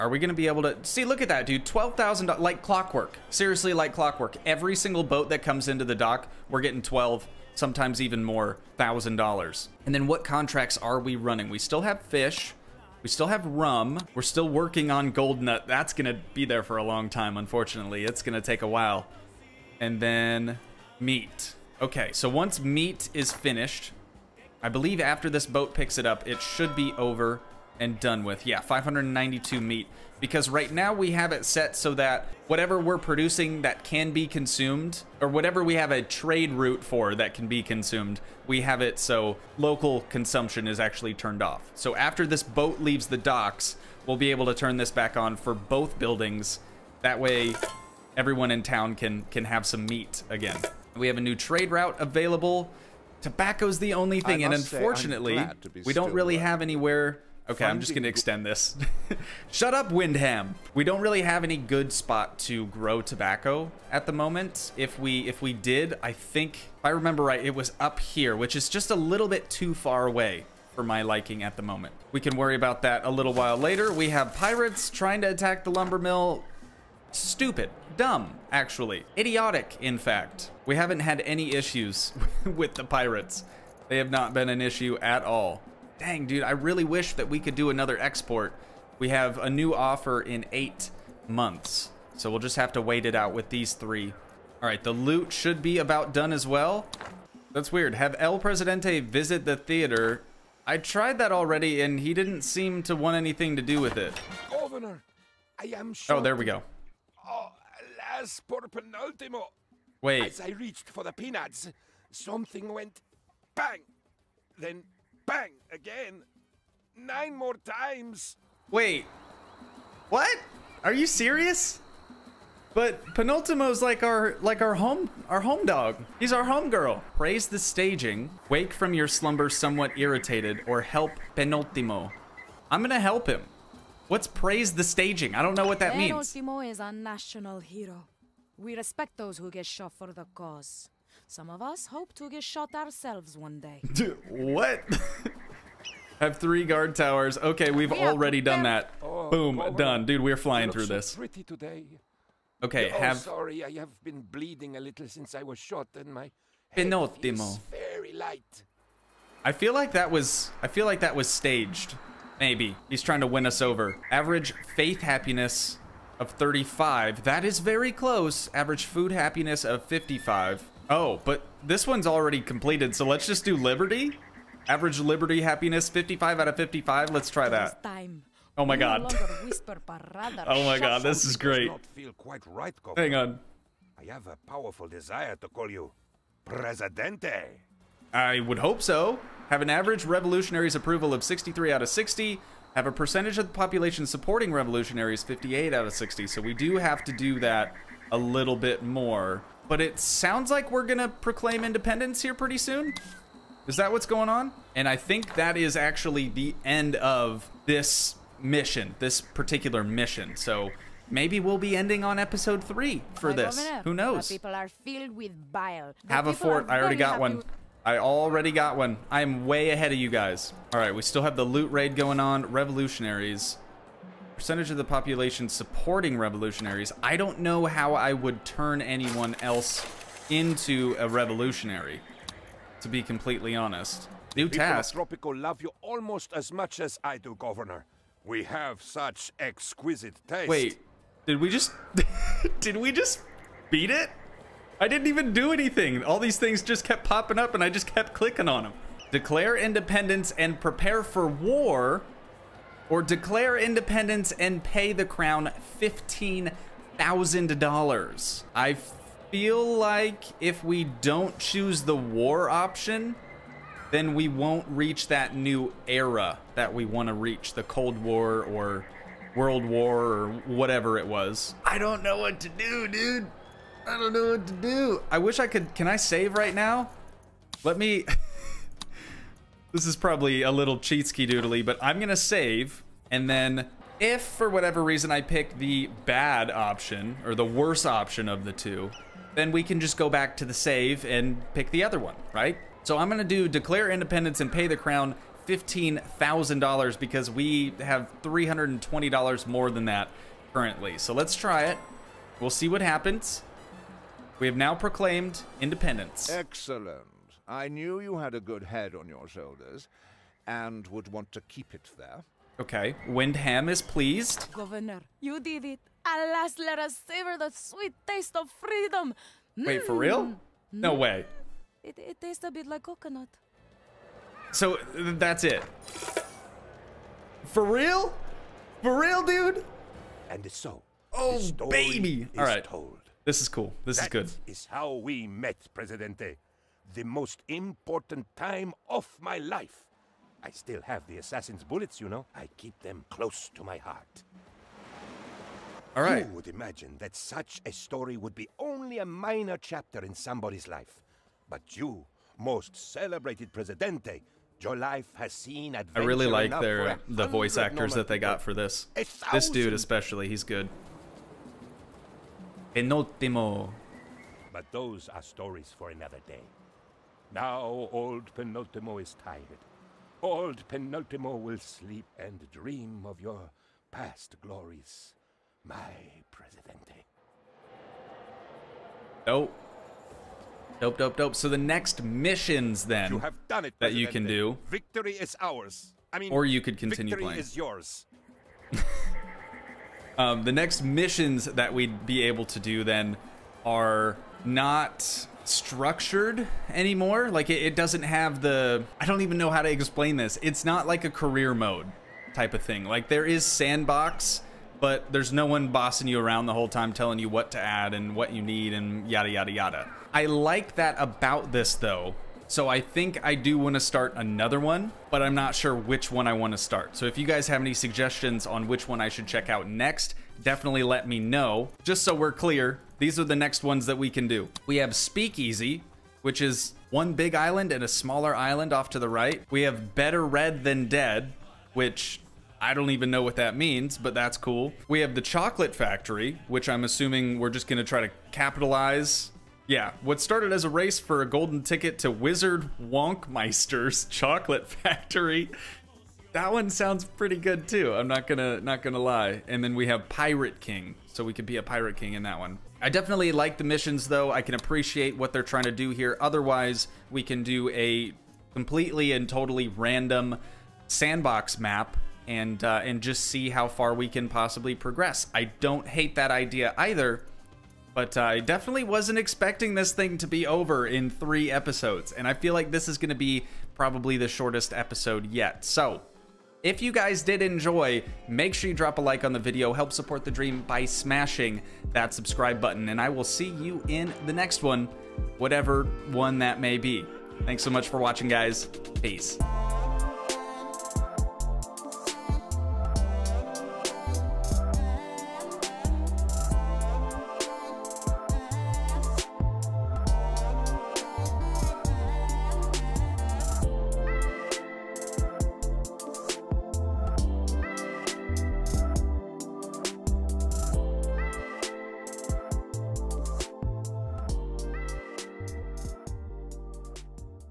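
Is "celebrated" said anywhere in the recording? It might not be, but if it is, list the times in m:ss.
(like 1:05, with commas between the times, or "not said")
5:52.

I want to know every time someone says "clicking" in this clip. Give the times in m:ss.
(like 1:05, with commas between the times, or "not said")
4:08.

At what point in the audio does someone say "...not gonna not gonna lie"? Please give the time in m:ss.
7:28.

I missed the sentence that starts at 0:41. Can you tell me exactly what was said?
So after this boat leaves the docks, we'll be able to turn this back on for both buildings.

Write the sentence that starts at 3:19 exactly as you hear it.
But it sounds like we're going to proclaim independence here pretty soon.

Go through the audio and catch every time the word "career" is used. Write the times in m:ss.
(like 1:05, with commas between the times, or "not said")
6:41.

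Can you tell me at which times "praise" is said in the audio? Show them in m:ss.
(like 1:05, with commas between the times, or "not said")
2:07, 2:14.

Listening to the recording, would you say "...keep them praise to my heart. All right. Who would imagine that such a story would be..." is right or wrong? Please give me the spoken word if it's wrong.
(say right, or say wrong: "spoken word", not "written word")
wrong: "close", not "praise".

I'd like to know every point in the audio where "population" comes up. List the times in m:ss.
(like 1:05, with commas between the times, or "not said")
3:13, 3:44.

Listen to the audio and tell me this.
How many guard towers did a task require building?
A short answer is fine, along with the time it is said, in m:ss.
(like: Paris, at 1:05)
3, at 2:26.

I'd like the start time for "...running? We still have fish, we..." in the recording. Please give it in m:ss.
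0:11.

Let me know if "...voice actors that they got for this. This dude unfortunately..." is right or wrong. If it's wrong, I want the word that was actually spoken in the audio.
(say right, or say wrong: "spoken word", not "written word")
wrong: "especially", not "unfortunately".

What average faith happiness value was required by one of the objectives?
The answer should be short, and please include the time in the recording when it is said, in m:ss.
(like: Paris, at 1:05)
35, at 2:46.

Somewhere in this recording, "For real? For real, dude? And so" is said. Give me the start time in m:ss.
5:27.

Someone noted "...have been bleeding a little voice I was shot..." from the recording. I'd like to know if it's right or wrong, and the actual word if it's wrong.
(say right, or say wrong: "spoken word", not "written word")
wrong: "since", not "voice".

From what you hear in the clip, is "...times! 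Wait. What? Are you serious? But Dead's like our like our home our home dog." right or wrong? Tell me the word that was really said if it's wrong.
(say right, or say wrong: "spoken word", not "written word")
wrong: "Penultimo", not "Dead".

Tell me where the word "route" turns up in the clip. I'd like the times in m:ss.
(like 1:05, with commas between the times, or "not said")
0:36, 0:51.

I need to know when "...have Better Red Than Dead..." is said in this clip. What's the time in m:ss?
7:09.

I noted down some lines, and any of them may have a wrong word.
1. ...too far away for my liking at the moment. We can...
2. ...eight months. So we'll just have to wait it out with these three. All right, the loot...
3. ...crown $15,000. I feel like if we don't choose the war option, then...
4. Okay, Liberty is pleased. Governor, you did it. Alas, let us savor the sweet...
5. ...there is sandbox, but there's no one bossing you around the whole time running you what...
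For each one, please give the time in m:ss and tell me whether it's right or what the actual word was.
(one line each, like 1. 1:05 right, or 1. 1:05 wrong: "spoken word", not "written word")
1. 1:09 right
2. 1:30 right
3. 4:15 right
4. 5:12 wrong: "Windham", not "Liberty"
5. 6:43 wrong: "telling", not "running".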